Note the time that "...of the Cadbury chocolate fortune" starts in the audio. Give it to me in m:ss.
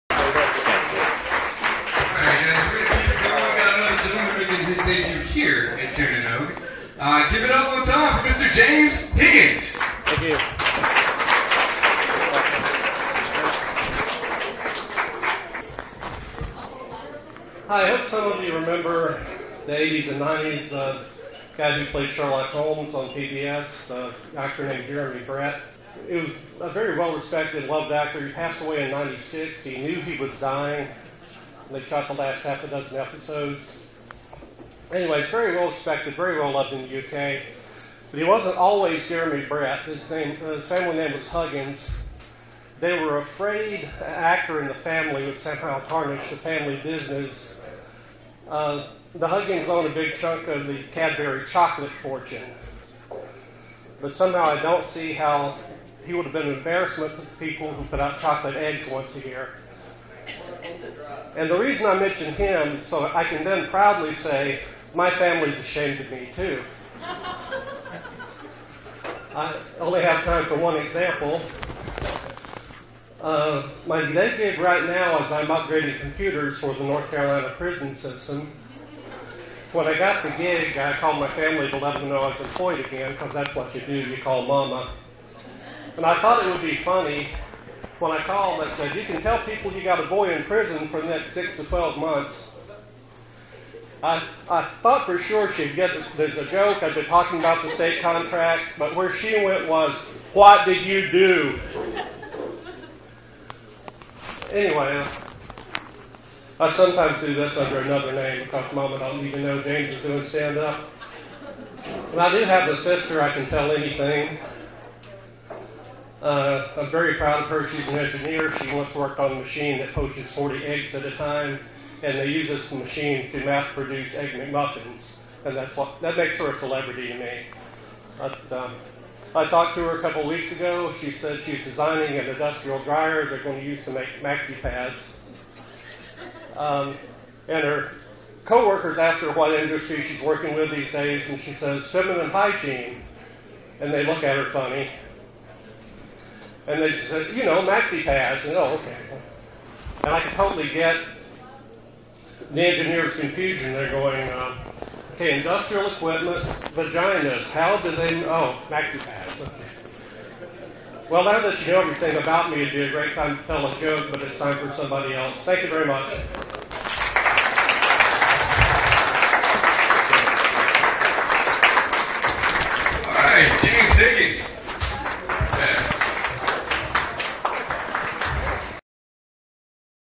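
0:50.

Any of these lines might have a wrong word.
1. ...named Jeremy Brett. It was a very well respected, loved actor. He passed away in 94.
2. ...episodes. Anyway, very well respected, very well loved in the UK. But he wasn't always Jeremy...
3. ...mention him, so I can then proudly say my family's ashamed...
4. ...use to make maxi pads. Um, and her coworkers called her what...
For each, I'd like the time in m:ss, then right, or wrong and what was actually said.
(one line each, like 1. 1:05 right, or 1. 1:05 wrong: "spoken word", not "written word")
1. 0:24 wrong: "96", not "94"
2. 0:32 right
3. 1:01 right
4. 2:13 wrong: "asked", not "called".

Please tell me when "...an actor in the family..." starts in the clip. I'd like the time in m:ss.
0:43.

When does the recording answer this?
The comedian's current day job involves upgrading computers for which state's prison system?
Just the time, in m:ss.
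1:16.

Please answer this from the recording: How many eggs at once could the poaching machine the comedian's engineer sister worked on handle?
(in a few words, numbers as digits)
40.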